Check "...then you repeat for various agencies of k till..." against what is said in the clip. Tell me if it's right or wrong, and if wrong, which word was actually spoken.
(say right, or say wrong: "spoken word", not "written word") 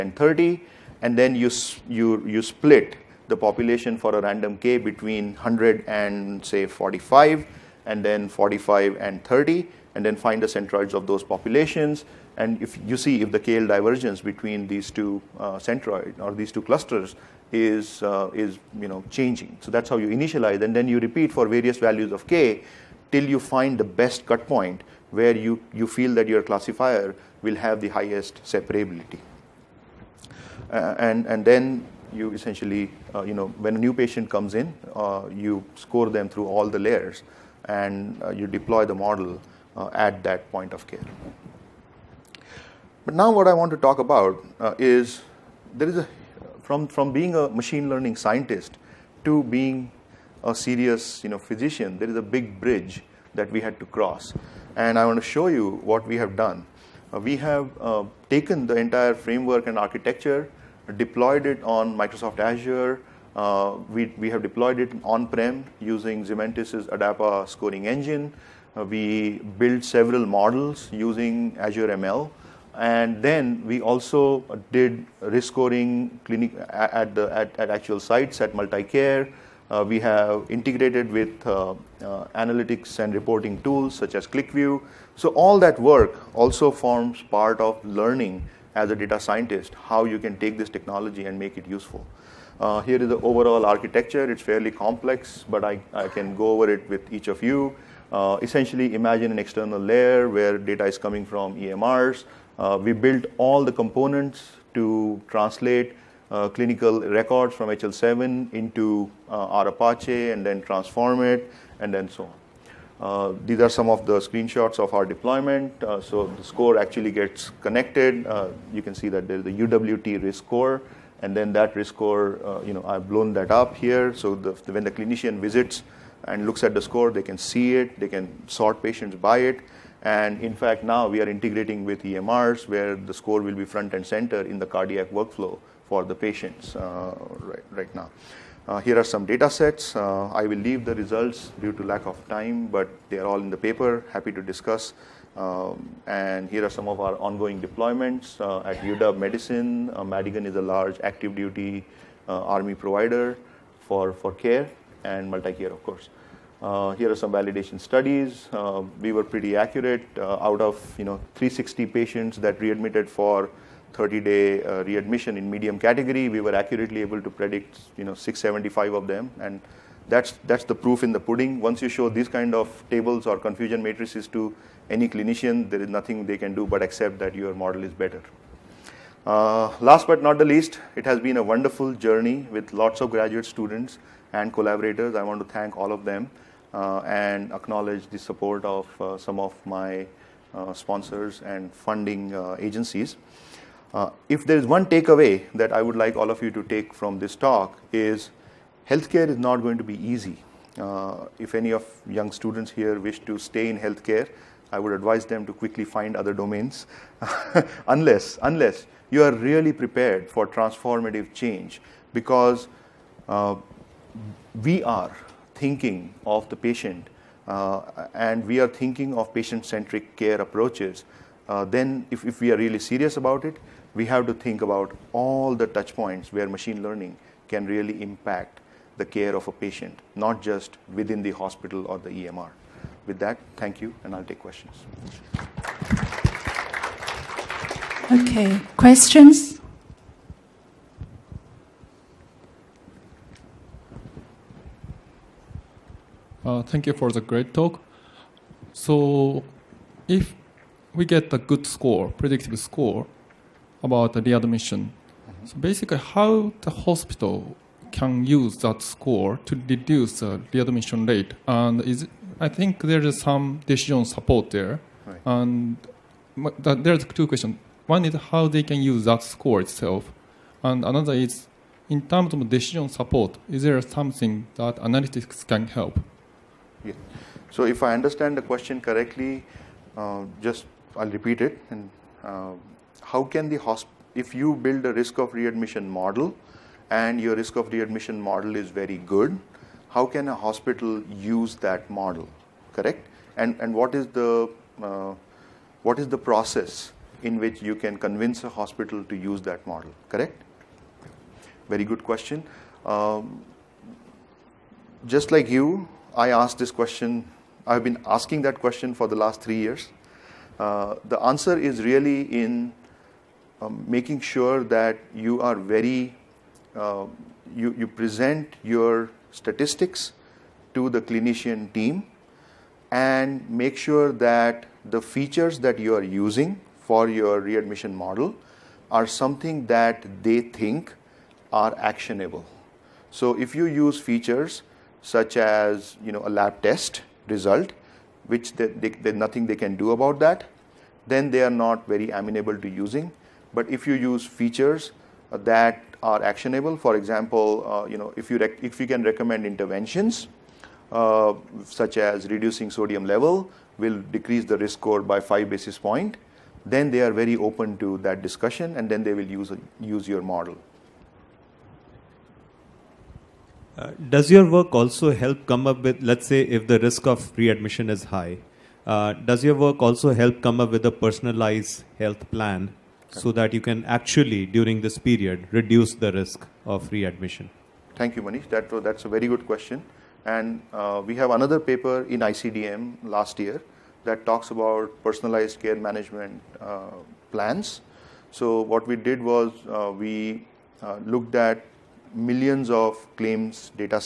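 wrong: "values", not "agencies".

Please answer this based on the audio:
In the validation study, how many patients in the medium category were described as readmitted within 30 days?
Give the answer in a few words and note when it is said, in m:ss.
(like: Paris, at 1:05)
360, at 2:41.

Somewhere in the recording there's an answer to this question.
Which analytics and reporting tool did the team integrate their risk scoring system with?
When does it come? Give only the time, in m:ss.
1:24.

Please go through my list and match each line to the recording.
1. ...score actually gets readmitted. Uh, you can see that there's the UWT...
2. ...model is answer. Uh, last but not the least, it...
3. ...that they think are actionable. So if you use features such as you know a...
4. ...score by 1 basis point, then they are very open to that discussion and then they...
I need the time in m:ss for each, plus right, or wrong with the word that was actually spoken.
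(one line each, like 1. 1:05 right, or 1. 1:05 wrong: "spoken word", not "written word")
1. 1:56 wrong: "connected", not "readmitted"
2. 2:57 wrong: "better", not "answer"
3. 5:29 right
4. 5:54 wrong: "5", not "1".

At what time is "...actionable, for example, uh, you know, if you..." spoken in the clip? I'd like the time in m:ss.
5:46.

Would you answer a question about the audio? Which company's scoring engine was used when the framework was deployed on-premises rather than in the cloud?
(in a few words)
Zementis ADAPA.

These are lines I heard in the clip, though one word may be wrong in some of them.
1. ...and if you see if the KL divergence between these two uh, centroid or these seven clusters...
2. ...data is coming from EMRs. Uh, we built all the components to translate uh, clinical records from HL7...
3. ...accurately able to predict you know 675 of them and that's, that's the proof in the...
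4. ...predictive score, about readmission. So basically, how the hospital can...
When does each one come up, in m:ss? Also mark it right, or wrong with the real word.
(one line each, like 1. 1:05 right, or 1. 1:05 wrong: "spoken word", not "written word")
1. 0:12 wrong: "two", not "seven"
2. 1:40 right
3. 2:46 right
4. 4:12 right.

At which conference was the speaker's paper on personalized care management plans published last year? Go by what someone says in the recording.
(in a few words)
ICDM.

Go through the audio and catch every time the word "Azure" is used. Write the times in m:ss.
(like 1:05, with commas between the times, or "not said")
1:02, 1:11.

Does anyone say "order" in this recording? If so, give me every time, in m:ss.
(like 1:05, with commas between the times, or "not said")
not said.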